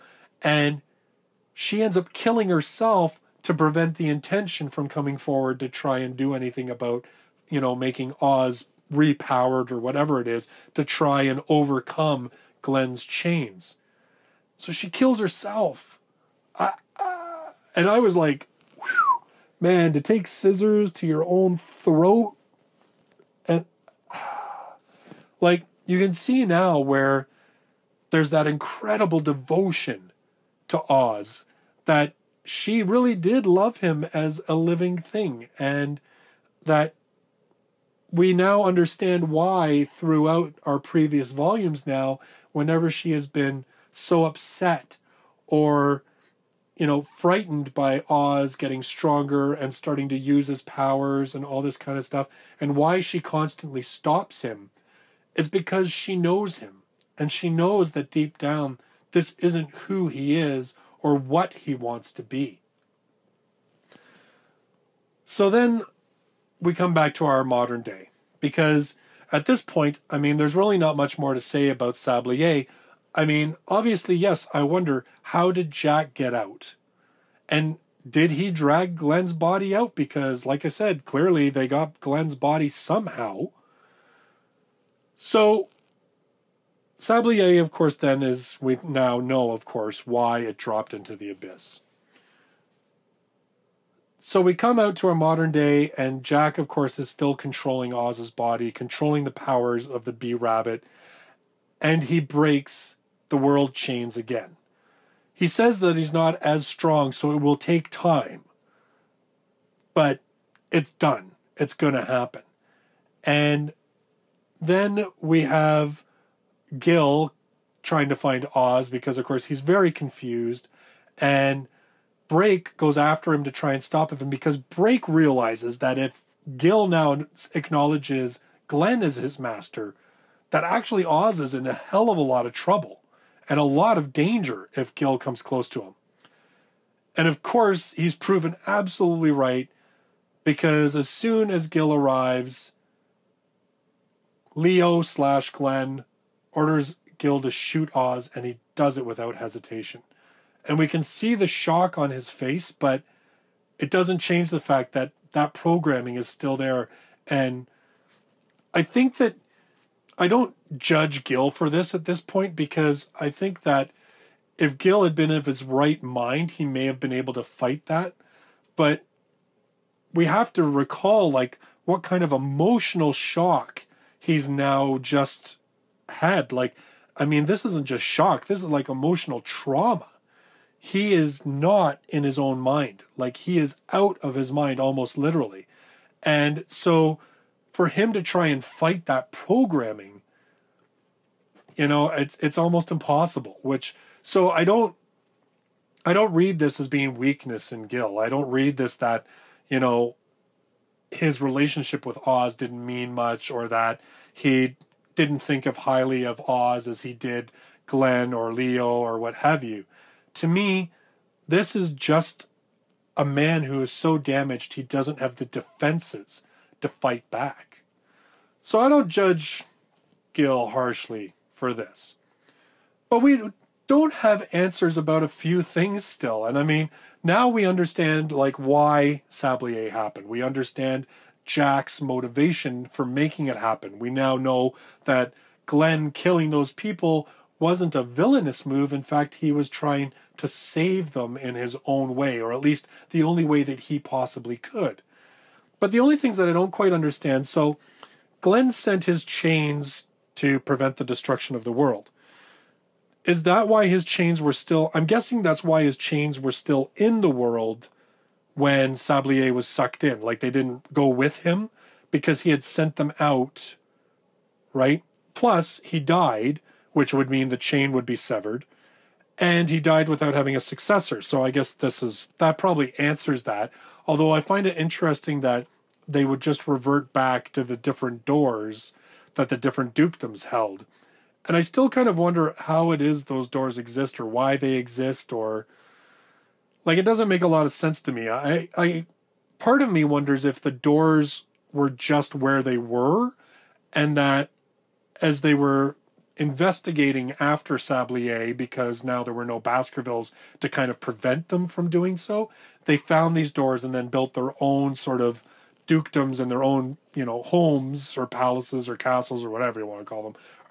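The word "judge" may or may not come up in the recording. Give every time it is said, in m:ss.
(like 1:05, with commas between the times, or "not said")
2:40, 3:39.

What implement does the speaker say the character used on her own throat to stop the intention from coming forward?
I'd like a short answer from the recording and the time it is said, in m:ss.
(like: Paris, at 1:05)
Scissors, at 0:20.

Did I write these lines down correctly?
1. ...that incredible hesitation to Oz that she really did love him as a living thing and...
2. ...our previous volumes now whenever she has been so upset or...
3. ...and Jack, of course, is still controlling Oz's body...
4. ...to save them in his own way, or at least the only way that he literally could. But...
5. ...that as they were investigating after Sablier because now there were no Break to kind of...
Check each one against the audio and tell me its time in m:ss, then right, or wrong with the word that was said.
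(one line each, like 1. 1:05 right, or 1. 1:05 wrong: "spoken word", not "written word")
1. 0:28 wrong: "devotion", not "hesitation"
2. 0:40 right
3. 1:35 right
4. 4:00 wrong: "possibly", not "literally"
5. 4:54 wrong: "Baskervilles", not "Break".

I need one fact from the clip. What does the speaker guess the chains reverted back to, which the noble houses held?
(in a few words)
Different doors.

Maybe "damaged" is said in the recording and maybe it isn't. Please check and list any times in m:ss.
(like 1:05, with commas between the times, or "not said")
3:34.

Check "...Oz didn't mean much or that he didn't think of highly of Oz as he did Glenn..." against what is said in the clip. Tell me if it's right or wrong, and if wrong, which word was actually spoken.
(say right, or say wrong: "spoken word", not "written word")
right.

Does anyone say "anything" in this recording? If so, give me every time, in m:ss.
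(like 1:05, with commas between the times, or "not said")
0:06.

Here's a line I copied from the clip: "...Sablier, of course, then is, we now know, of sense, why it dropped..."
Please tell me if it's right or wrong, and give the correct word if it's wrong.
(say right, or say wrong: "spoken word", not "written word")
wrong: "course", not "sense".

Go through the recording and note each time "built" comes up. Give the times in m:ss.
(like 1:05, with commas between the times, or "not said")
5:04.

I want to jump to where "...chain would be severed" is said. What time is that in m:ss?
4:27.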